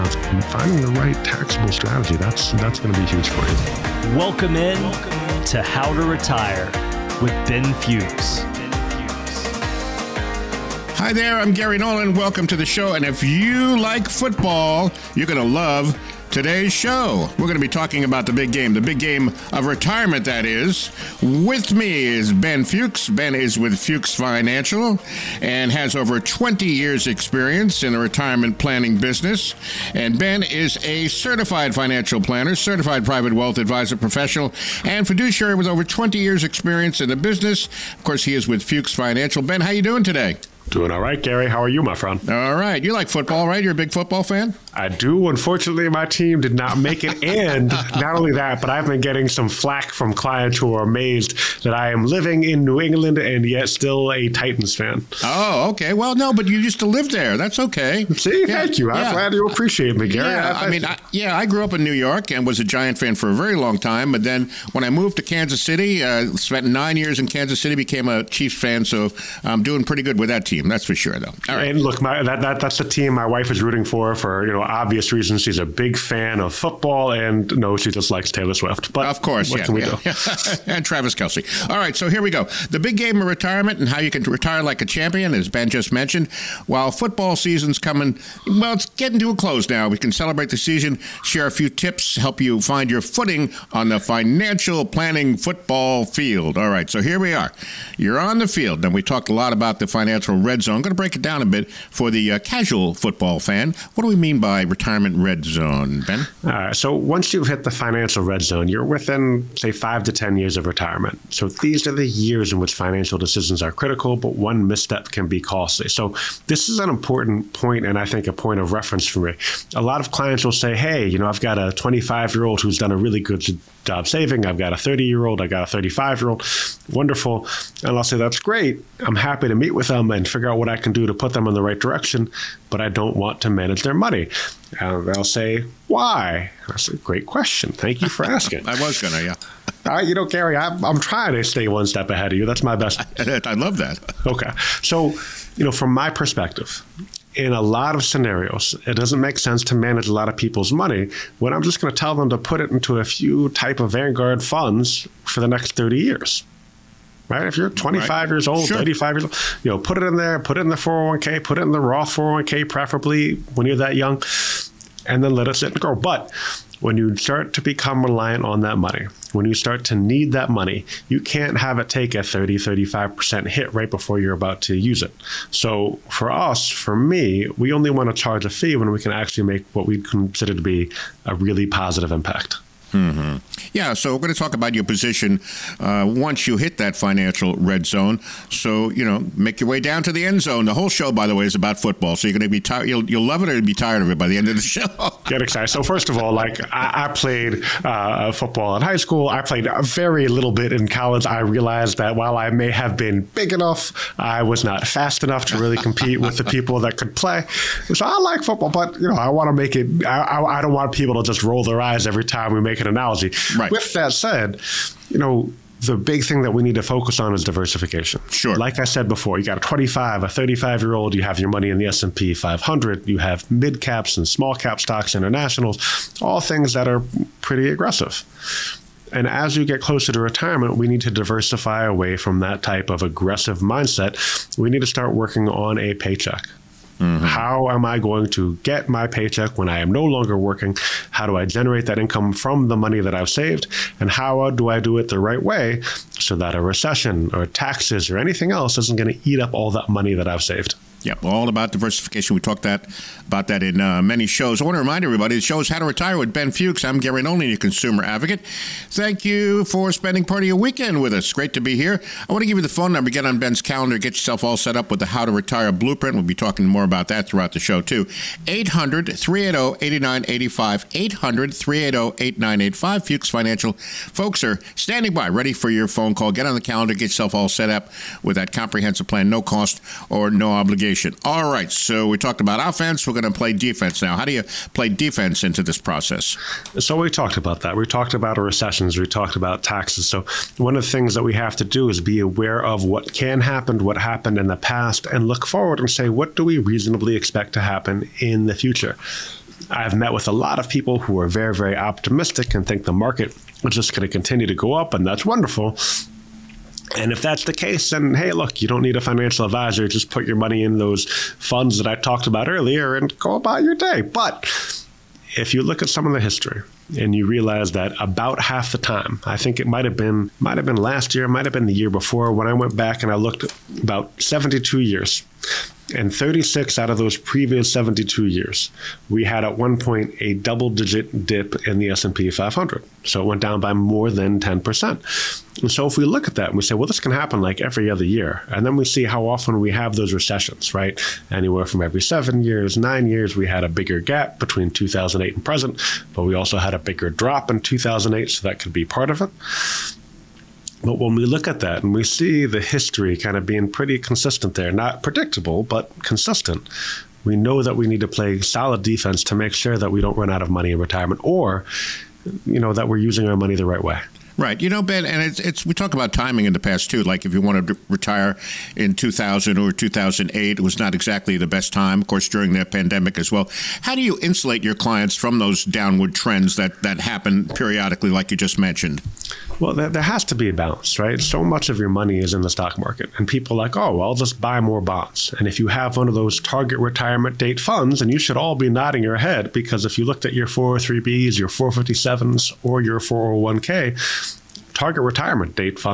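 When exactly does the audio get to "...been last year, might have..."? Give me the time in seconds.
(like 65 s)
320 s.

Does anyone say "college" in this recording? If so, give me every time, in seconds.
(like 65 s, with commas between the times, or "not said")
200 s.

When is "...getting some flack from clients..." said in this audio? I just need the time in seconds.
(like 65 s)
49 s.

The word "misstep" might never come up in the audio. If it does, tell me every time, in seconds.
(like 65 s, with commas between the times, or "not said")
114 s.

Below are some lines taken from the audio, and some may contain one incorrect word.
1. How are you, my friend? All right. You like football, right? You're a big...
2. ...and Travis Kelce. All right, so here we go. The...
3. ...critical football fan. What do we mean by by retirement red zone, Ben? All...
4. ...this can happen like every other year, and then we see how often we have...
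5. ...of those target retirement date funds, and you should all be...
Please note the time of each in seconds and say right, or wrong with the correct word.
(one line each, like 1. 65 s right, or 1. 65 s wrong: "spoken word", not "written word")
1. 41 s right
2. 80 s right
3. 102 s wrong: "casual", not "critical"
4. 336 s right
5. 386 s right.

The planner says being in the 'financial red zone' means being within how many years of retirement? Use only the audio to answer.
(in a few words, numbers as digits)
5 to 10 years.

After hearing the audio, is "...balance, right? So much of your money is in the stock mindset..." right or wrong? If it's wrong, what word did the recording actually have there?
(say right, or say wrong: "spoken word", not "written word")
wrong: "market", not "mindset".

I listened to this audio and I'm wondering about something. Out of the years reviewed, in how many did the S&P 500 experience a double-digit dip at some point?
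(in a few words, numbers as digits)
36.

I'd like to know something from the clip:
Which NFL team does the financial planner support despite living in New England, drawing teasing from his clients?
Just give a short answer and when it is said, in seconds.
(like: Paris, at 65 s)
Titans, at 54 s.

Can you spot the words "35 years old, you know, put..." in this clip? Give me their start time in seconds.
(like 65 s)
158 s.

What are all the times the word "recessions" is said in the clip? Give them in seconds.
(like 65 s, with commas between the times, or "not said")
246 s, 288 s, 340 s.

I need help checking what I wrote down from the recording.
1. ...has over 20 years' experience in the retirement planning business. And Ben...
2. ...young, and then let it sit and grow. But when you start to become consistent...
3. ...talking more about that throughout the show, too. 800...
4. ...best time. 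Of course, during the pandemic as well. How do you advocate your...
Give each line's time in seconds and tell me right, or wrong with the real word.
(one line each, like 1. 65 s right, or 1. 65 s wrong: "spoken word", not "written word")
1. 25 s right
2. 163 s wrong: "reliant", not "consistent"
3. 266 s right
4. 371 s wrong: "insulate", not "advocate".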